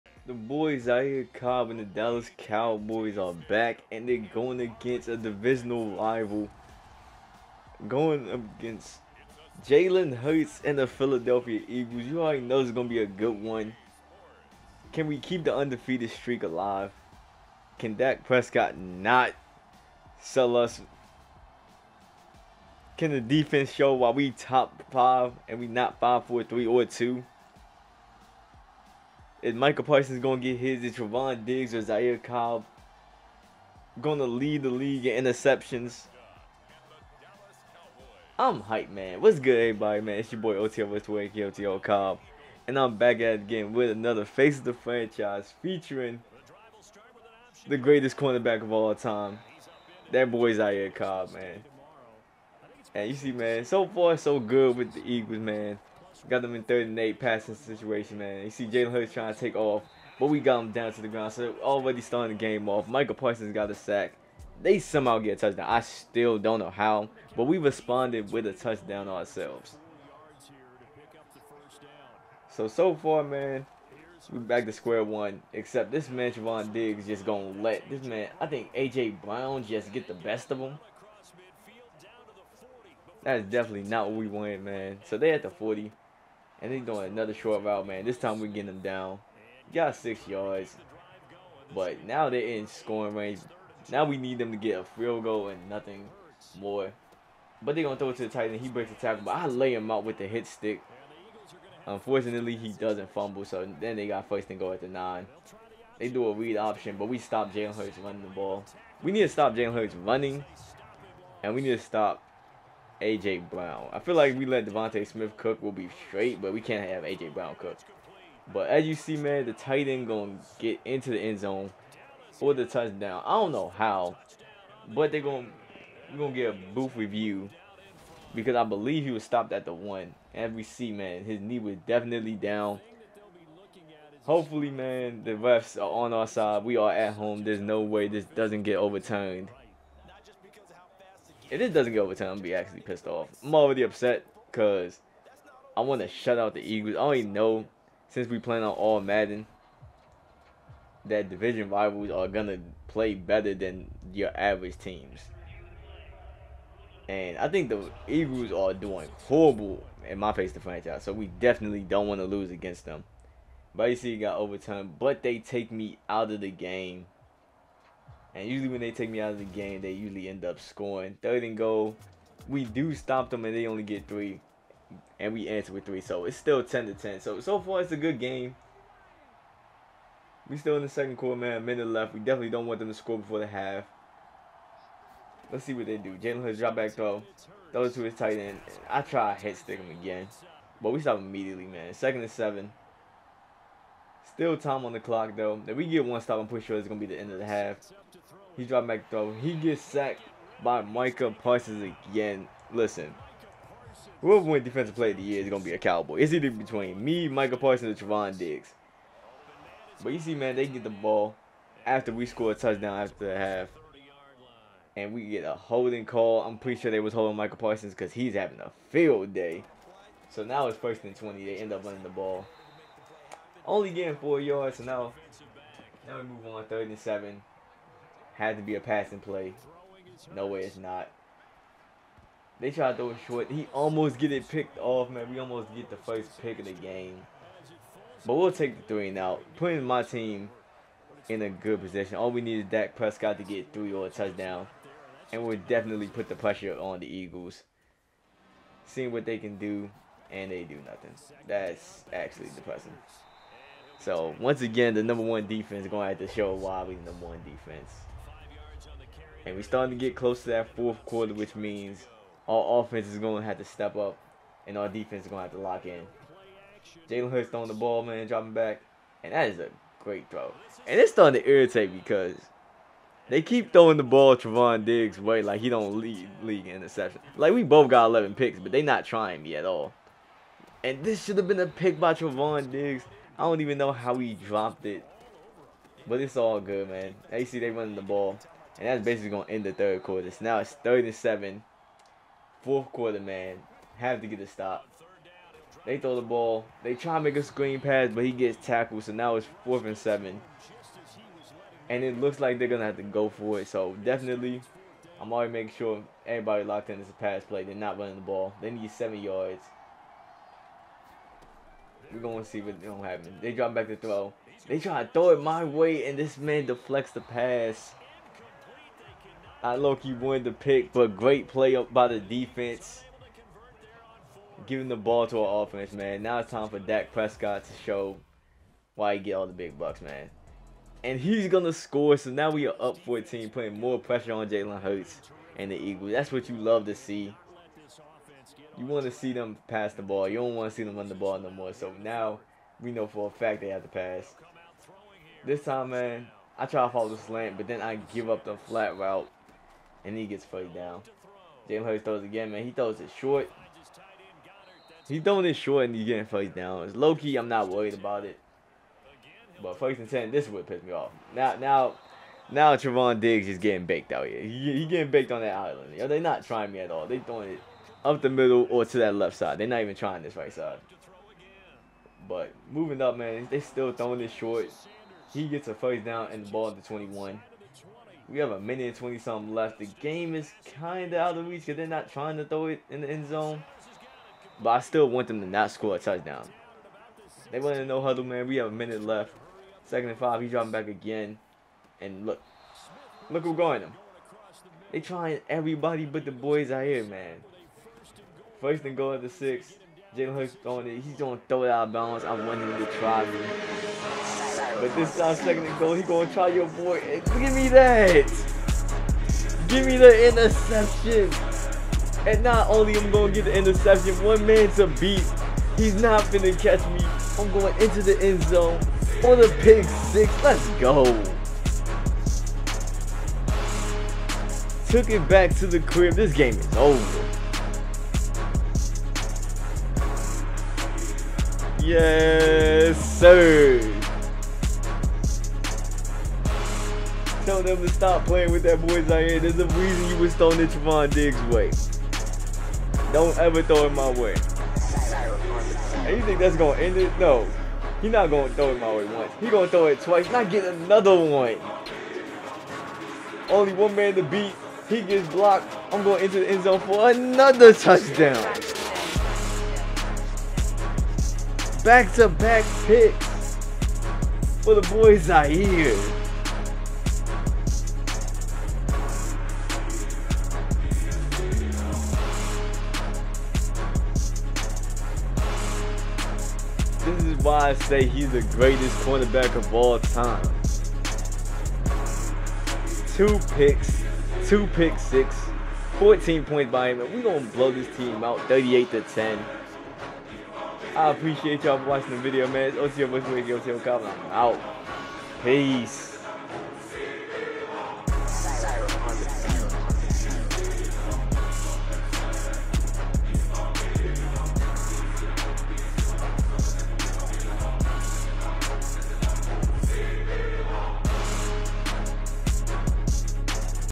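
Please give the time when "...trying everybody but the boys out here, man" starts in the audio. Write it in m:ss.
6:35.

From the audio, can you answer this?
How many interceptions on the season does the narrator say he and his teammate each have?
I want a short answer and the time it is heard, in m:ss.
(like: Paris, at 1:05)
11, at 4:38.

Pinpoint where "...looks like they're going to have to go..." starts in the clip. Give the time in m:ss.
5:02.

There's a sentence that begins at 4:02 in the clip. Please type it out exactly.
All we need is Dak Prescott to get three or a touchdown.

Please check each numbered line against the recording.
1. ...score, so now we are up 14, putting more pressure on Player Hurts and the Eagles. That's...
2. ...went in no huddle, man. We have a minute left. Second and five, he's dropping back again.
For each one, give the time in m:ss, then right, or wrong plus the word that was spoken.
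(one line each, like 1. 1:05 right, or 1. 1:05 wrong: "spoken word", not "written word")
1. 5:31 wrong: "Jalen", not "Player"
2. 6:27 right.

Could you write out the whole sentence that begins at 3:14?
Still time on the clock, though.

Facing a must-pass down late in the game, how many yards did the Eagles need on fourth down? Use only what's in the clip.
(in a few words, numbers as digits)
7.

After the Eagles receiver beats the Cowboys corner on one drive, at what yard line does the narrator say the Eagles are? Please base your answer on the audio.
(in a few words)
40.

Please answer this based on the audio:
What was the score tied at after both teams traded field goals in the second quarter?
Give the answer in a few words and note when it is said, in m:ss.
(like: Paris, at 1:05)
10 to 10, at 2:56.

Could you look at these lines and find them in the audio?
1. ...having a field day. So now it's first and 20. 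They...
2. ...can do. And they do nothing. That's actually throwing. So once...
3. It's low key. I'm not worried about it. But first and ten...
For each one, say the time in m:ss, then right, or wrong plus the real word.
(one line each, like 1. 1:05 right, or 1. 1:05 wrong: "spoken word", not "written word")
1. 3:38 right
2. 4:09 wrong: "depressing", not "throwing"
3. 5:56 right.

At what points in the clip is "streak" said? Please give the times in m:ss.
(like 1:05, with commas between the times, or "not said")
0:16.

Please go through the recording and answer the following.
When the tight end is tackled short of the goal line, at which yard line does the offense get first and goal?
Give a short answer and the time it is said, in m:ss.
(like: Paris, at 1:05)
9, at 1:44.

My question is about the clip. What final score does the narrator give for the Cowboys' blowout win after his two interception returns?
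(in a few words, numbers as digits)
38 to 10.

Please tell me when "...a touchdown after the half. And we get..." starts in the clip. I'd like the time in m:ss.
3:32.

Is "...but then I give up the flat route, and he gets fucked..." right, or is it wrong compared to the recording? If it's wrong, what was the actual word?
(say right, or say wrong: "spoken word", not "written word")
right.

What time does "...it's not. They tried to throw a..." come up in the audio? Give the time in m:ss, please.
3:50.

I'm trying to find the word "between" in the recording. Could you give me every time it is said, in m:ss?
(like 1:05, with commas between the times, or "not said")
3:26.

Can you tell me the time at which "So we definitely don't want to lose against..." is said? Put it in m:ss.
2:41.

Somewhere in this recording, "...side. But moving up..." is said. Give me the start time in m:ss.
6:10.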